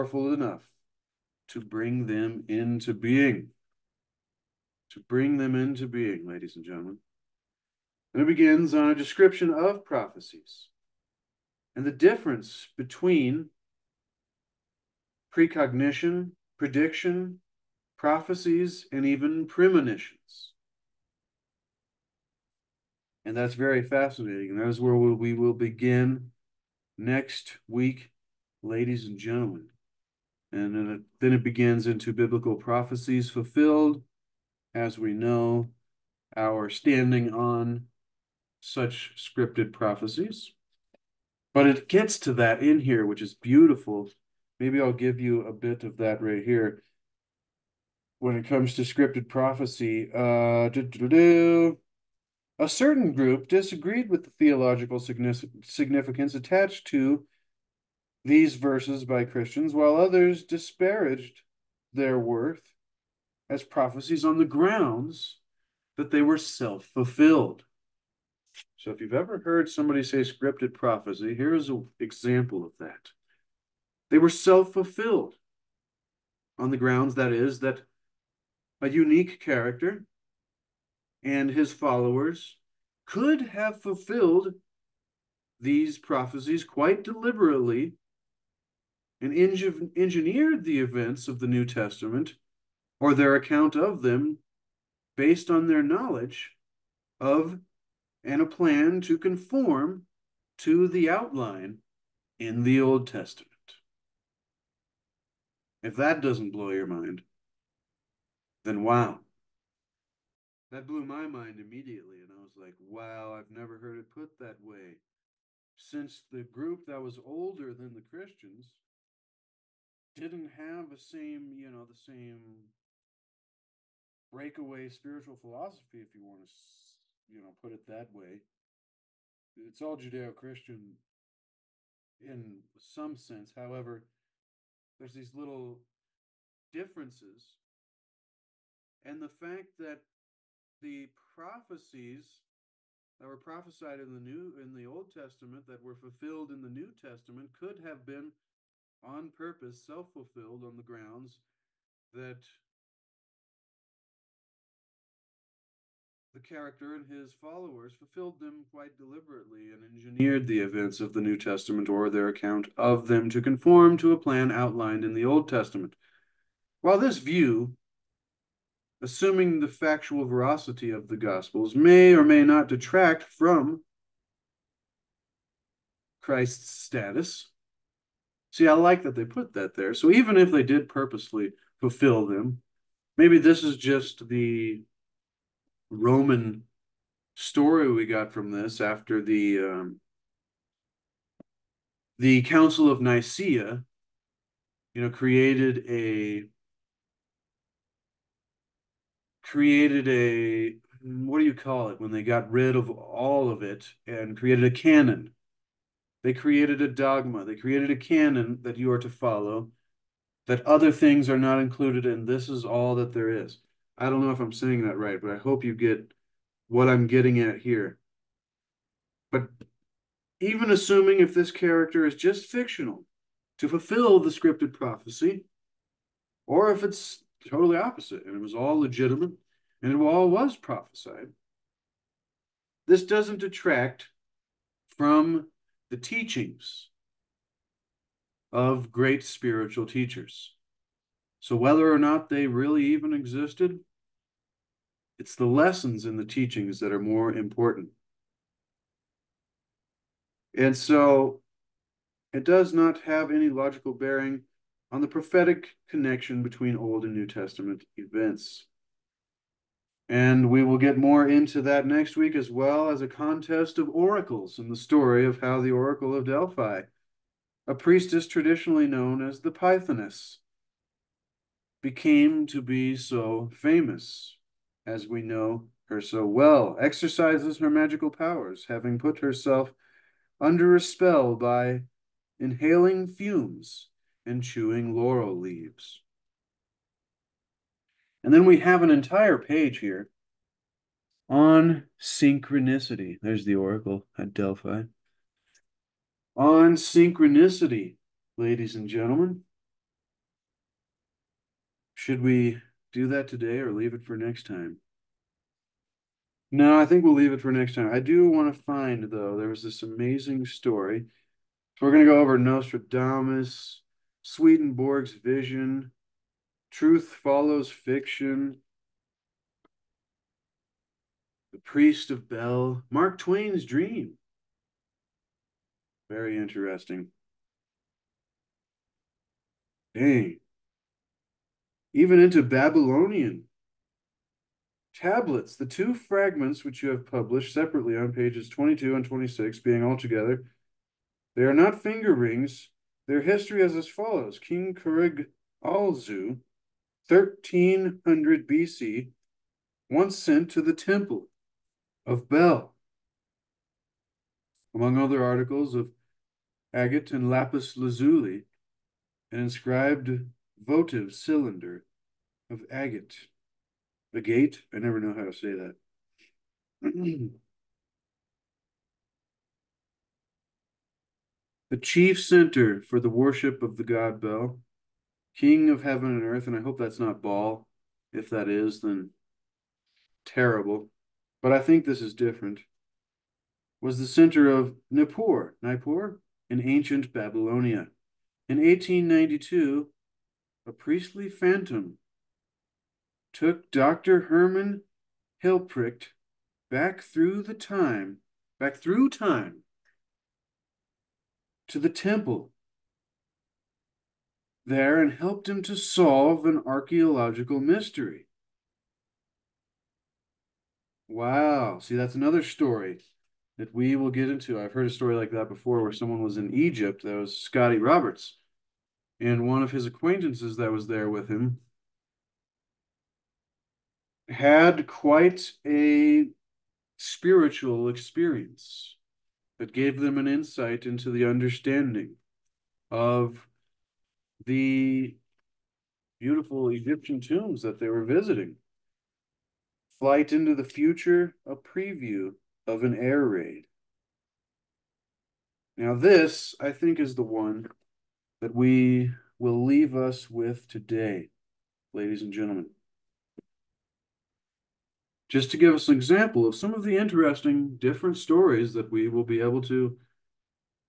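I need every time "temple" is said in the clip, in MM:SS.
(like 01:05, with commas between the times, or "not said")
05:50, 06:41.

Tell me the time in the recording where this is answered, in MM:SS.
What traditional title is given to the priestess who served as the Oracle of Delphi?
04:29.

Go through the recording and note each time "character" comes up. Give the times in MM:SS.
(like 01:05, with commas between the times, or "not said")
01:19, 02:36, 03:41.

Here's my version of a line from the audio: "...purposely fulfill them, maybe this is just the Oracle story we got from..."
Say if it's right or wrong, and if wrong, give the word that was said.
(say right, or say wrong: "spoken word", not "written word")
wrong: "Roman", not "Oracle".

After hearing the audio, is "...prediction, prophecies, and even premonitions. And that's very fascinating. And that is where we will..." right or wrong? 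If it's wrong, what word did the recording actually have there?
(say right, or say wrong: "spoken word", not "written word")
right.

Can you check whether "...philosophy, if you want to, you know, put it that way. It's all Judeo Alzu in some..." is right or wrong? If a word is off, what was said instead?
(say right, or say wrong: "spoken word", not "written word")
wrong: "Christian", not "Alzu".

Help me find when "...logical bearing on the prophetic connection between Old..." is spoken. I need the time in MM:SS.
04:13.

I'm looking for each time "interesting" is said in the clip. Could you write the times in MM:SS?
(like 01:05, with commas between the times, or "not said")
05:26, 07:36.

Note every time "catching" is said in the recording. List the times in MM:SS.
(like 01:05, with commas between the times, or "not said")
not said.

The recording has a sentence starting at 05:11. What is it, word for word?
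So we're going to go over Nostradamus, Swedenborg's vision, truth follows fiction, the priest of Bel, Mark Twain's dream.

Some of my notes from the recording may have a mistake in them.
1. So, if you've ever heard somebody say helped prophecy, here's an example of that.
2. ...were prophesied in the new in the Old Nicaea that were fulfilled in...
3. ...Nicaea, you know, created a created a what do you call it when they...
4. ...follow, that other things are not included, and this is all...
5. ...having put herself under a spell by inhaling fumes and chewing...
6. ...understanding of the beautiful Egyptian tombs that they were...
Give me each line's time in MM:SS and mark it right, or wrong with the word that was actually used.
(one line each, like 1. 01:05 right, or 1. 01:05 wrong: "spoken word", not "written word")
1. 01:08 wrong: "scripted", not "helped"
2. 02:23 wrong: "Testament", not "Nicaea"
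3. 03:13 right
4. 03:29 right
5. 04:38 right
6. 07:11 right.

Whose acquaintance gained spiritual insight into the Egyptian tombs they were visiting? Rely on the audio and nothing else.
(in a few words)
Scotty Roberts.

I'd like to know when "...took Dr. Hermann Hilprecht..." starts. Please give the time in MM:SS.
06:33.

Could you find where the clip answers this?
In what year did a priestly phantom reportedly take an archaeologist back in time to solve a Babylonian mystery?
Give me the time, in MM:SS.
06:28.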